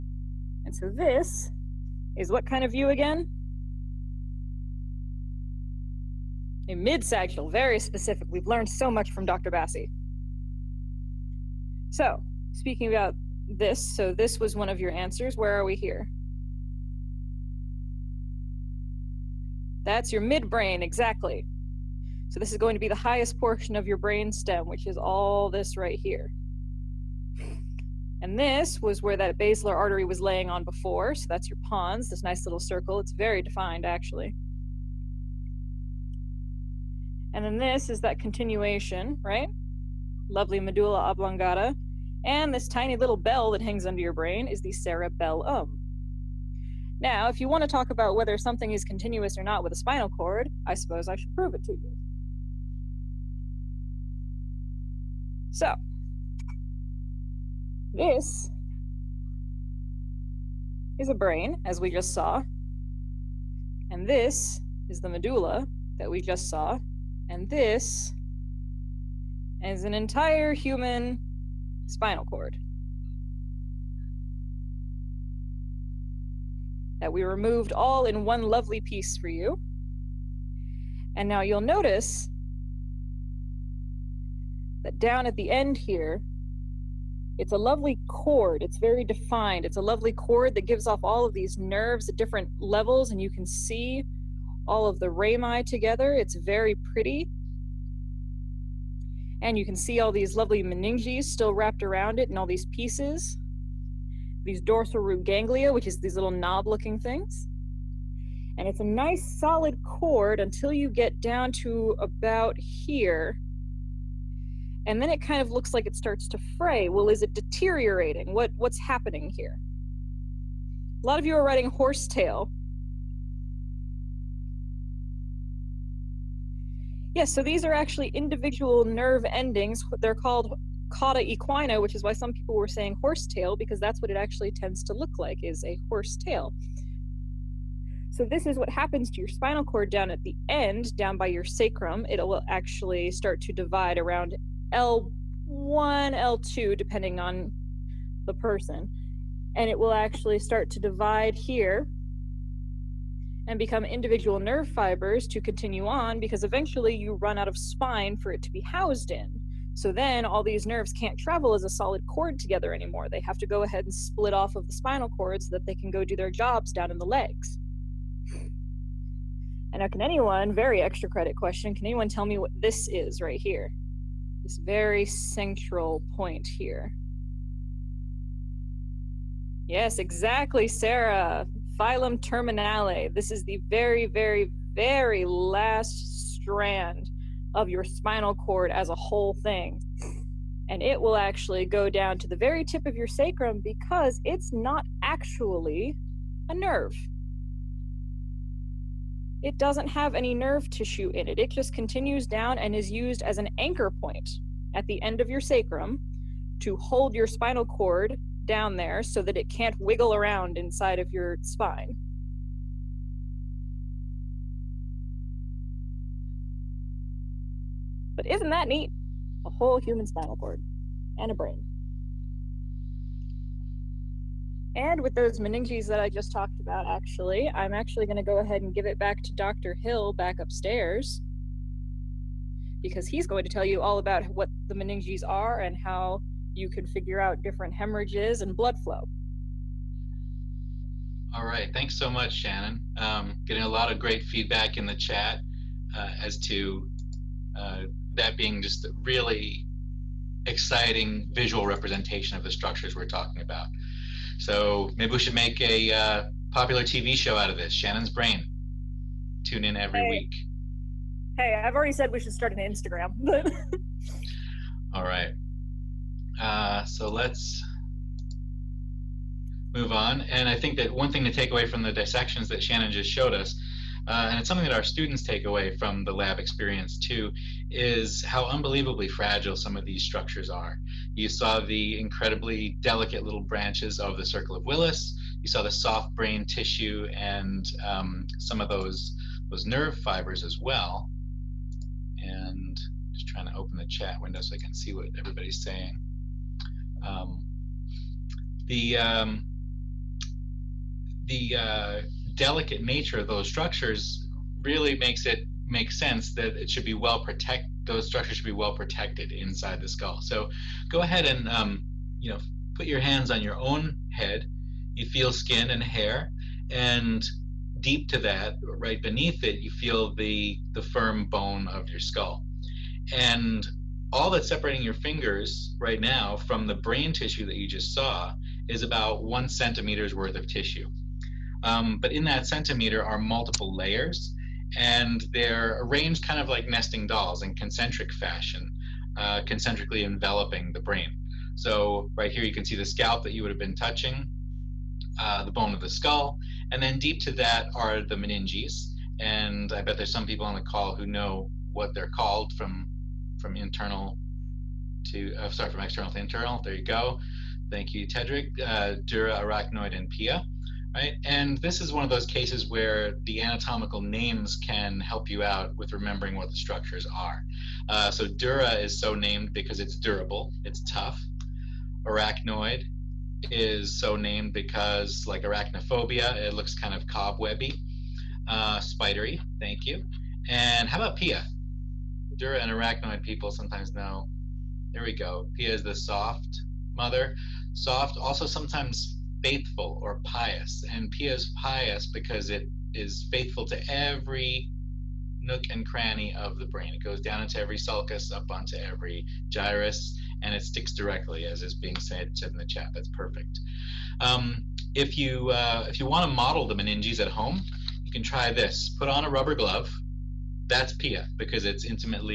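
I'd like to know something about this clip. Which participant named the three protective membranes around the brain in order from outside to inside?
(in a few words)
Tedric.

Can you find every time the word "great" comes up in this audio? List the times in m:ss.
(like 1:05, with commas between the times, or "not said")
4:03.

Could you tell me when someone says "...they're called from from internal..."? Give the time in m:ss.
5:51.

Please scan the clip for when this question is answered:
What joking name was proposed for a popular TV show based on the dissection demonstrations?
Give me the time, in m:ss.
4:17.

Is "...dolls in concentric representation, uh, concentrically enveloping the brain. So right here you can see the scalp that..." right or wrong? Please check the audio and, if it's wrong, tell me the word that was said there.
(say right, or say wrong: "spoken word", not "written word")
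wrong: "fashion", not "representation".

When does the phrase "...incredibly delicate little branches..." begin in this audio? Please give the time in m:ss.
4:41.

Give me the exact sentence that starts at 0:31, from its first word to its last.
So that's your pons, this nice little circle.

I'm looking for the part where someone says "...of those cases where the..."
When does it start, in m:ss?
6:02.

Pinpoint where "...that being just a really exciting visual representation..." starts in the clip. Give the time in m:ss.
4:08.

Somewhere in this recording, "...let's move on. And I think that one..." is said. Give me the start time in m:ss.
4:27.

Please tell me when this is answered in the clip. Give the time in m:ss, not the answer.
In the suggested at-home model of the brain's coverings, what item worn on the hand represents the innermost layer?
6:49.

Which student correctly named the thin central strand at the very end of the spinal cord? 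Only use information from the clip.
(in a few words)
Sarah.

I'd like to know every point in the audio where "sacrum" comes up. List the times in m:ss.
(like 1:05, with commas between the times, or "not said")
2:21, 3:13, 3:25.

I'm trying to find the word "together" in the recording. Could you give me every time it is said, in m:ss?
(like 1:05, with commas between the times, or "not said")
1:35, 2:42.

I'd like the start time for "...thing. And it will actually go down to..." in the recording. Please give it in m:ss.
3:09.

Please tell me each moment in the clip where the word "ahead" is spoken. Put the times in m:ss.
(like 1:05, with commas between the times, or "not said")
2:43, 3:48, 5:11.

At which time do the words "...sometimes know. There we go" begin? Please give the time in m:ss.
6:23.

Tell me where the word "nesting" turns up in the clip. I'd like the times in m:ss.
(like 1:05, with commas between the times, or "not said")
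5:36.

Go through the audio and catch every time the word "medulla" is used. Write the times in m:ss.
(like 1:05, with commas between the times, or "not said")
0:40, 1:05.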